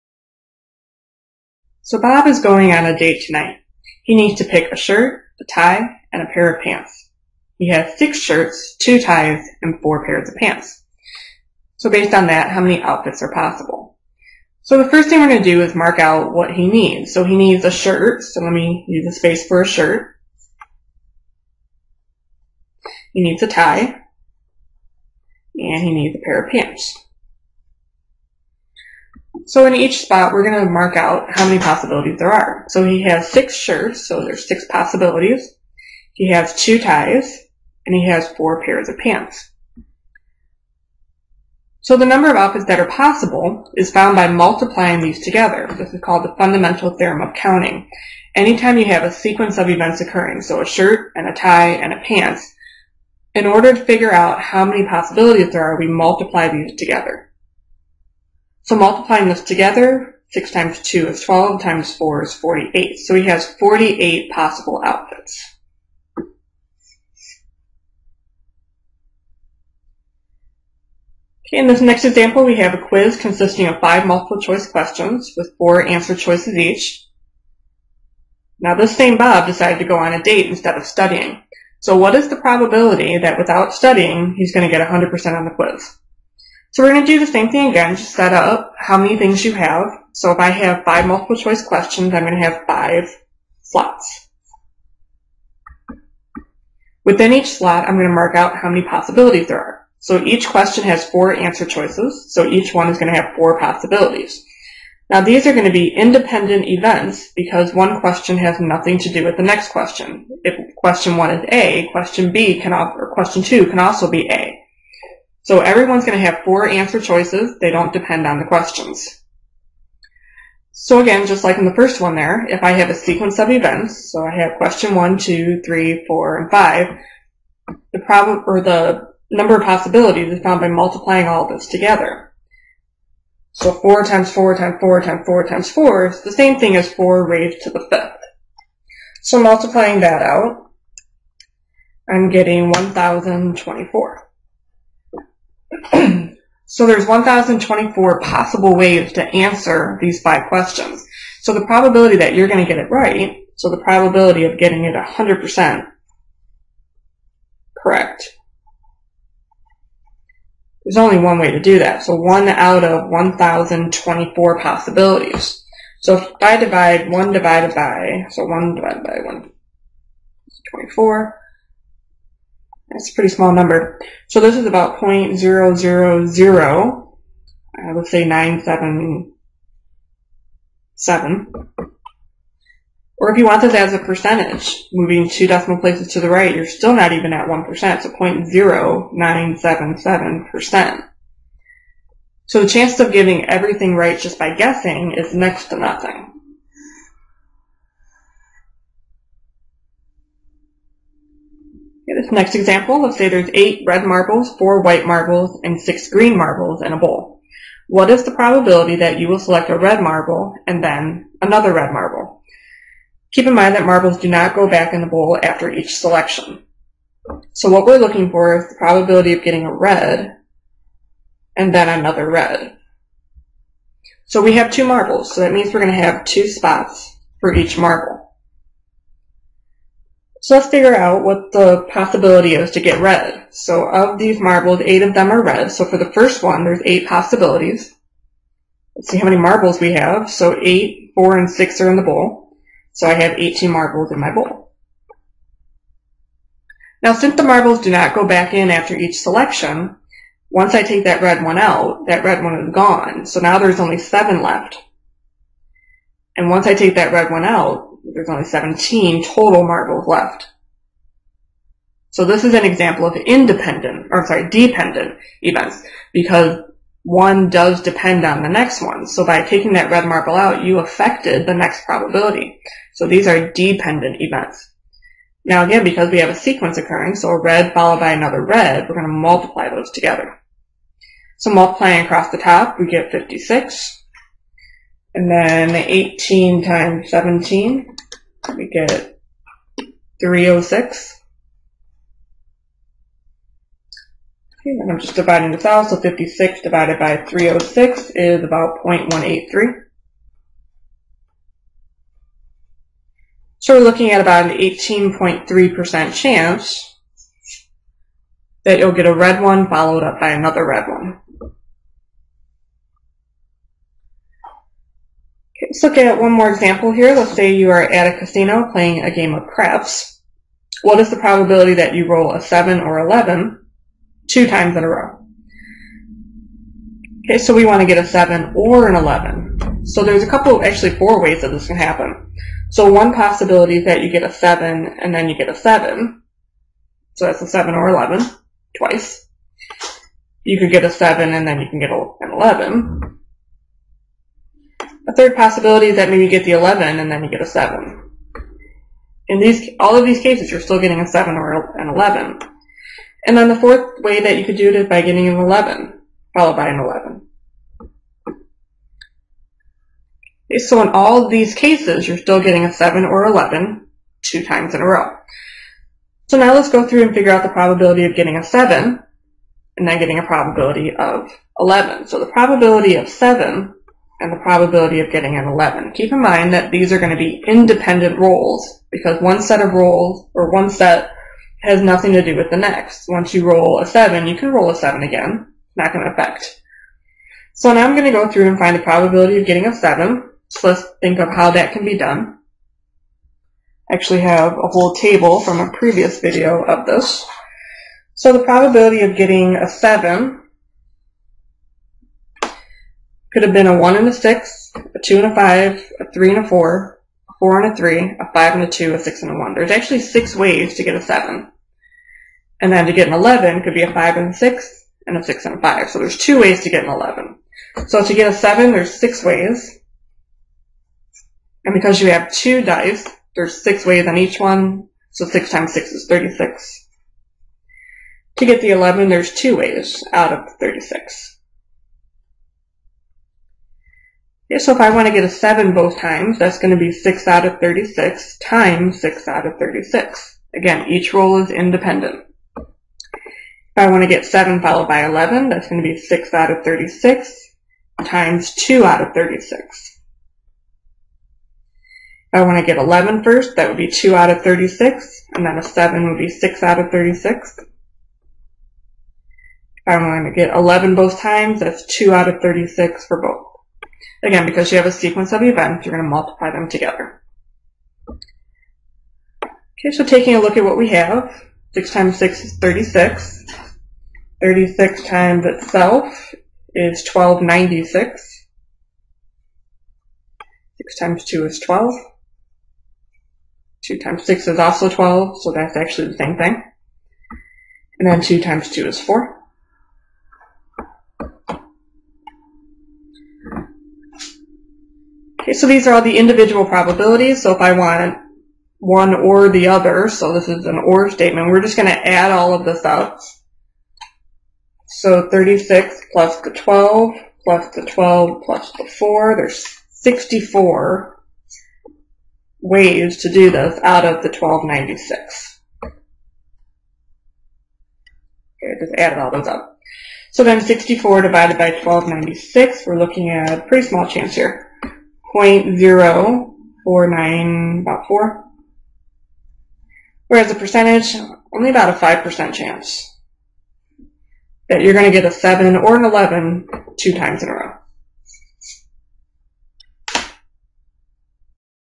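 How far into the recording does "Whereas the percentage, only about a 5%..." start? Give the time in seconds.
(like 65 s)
530 s.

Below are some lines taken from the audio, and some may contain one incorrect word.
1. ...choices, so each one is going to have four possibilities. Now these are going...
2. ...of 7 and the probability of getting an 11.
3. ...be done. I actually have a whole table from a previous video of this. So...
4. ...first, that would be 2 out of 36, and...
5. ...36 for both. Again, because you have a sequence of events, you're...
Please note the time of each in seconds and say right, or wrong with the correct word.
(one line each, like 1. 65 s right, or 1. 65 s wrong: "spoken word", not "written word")
1. 101 s right
2. 372 s right
3. 391 s right
4. 453 s right
5. 462 s right.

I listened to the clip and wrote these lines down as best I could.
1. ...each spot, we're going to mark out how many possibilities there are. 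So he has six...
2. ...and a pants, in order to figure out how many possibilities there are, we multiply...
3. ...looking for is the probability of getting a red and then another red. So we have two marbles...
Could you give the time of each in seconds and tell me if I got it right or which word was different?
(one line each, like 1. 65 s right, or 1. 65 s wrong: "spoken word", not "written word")
1. 29 s right
2. 51 s right
3. 217 s right.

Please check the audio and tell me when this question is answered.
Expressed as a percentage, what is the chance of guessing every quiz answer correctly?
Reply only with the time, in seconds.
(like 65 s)
188 s.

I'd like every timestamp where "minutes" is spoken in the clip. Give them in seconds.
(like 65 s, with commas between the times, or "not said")
not said.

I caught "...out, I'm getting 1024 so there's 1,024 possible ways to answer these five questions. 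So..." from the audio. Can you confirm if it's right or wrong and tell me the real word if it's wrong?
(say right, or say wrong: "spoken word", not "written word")
right.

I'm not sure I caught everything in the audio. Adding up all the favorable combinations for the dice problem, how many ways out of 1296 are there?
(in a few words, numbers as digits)
64.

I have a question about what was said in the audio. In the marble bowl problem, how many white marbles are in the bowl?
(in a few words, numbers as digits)
4.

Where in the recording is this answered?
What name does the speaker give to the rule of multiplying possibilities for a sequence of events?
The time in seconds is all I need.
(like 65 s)
46 s.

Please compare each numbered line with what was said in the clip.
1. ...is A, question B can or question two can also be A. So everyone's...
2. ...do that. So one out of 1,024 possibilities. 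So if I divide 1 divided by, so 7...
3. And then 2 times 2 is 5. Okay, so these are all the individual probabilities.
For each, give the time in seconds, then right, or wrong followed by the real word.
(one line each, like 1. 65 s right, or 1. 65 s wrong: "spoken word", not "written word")
1. 111 s right
2. 161 s wrong: "1", not "7"
3. 487 s wrong: "4", not "5".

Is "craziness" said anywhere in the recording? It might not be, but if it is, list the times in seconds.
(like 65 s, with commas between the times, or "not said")
not said.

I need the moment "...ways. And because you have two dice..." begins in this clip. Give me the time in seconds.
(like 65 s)
419 s.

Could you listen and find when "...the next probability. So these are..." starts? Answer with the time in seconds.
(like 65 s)
271 s.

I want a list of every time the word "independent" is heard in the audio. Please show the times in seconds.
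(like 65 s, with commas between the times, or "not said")
105 s, 263 s, 377 s, 441 s.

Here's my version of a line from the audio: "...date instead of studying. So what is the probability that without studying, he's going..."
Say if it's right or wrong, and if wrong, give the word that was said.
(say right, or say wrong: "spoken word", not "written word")
right.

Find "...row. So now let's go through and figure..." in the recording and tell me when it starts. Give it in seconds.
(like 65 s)
364 s.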